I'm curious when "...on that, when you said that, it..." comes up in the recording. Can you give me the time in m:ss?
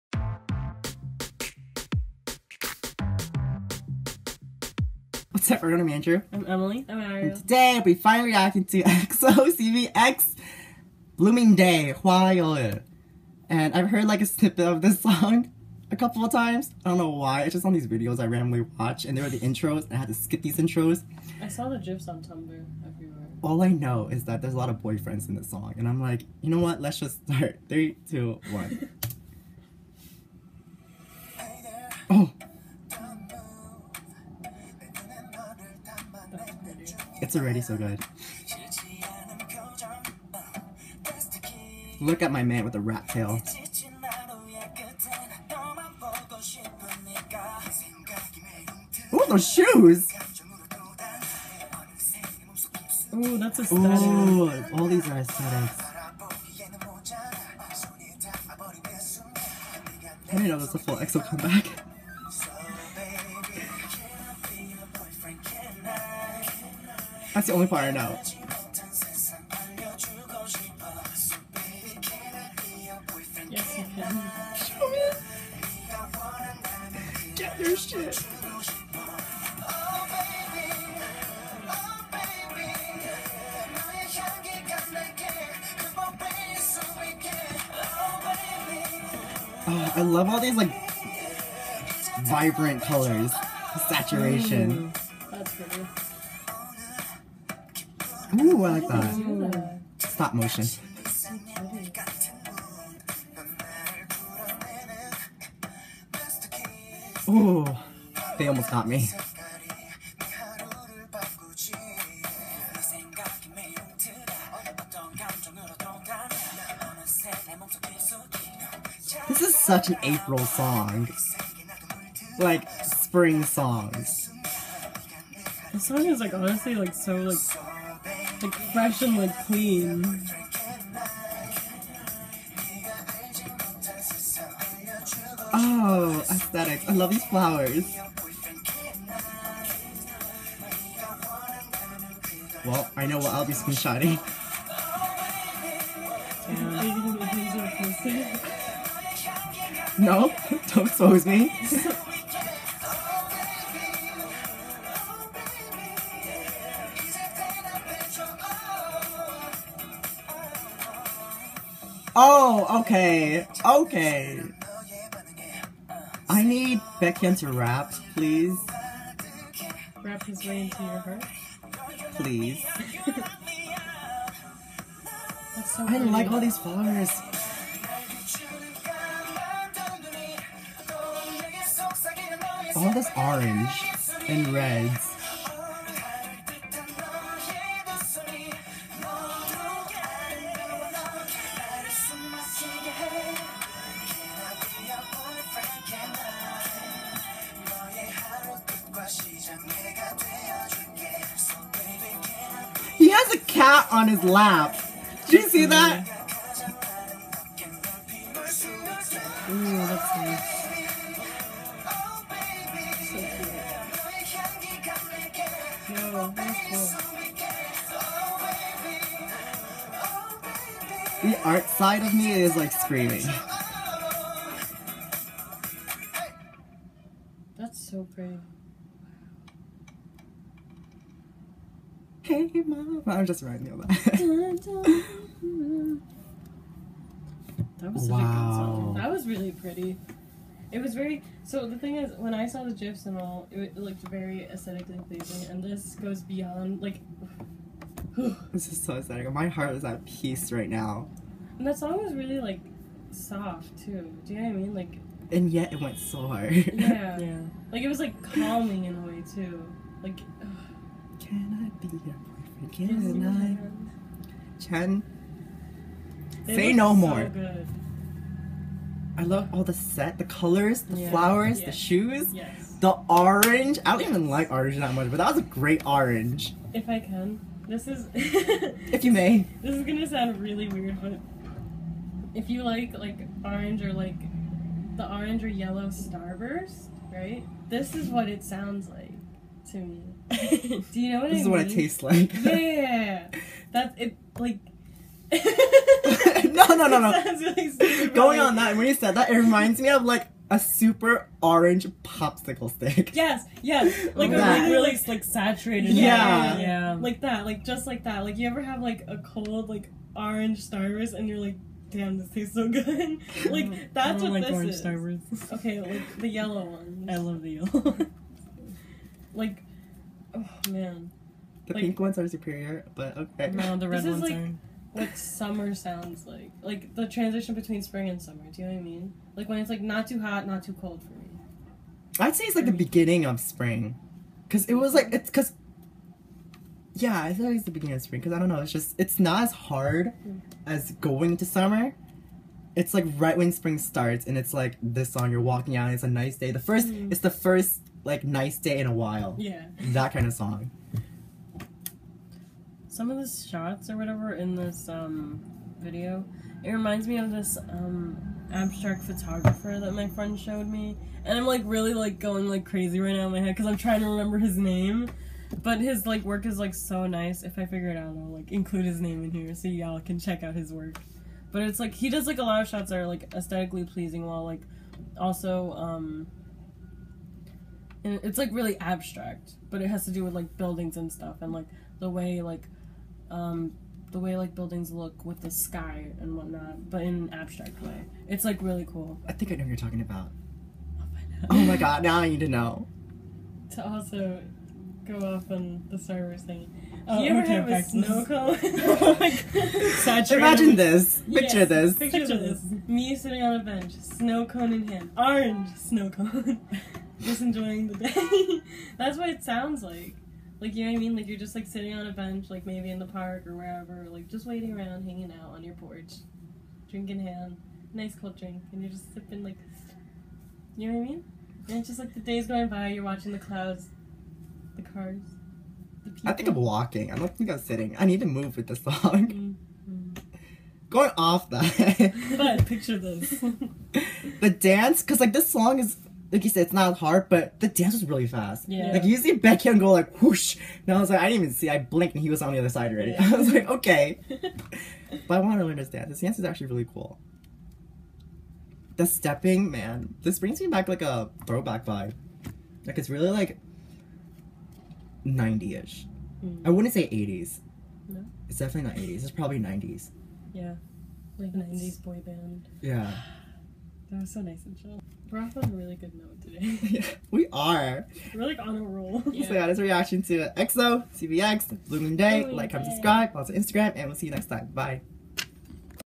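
4:58.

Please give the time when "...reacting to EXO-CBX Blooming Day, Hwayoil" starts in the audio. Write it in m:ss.
0:08.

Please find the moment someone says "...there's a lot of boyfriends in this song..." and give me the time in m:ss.
0:24.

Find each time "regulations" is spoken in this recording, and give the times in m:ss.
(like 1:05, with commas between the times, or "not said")
not said.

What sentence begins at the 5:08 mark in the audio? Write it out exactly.
Like you ever have like a cold like orange Starburst and you're like, damn, this tastes so good.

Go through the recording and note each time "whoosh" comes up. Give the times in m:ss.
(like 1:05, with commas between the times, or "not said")
7:20.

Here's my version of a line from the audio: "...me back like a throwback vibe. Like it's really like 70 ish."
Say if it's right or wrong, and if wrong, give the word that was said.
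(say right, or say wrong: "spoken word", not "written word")
wrong: "90", not "70".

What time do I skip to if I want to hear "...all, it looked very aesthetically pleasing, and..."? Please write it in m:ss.
4:03.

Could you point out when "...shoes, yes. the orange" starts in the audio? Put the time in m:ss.
4:31.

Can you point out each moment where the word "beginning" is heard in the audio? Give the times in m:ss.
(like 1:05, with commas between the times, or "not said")
5:32, 5:37.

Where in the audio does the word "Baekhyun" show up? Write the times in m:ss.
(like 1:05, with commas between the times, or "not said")
2:46, 7:19.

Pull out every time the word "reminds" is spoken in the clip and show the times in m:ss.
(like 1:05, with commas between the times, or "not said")
4:59, 5:56.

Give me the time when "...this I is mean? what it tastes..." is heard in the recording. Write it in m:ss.
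4:51.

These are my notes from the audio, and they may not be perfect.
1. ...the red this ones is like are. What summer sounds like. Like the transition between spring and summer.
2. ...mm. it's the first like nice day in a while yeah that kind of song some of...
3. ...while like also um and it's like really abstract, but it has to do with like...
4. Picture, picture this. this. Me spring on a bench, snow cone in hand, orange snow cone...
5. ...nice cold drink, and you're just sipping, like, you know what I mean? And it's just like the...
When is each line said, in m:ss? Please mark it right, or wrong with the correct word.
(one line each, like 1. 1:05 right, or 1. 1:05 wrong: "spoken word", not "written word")
1. 5:23 right
2. 5:46 right
3. 6:14 right
4. 6:41 wrong: "sitting", not "spring"
5. 6:57 right.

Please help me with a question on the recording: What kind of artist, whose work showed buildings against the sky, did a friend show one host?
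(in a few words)
Abstract photographer.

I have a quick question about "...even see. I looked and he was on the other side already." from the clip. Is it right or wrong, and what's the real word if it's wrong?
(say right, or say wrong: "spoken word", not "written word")
wrong: "blinked", not "looked".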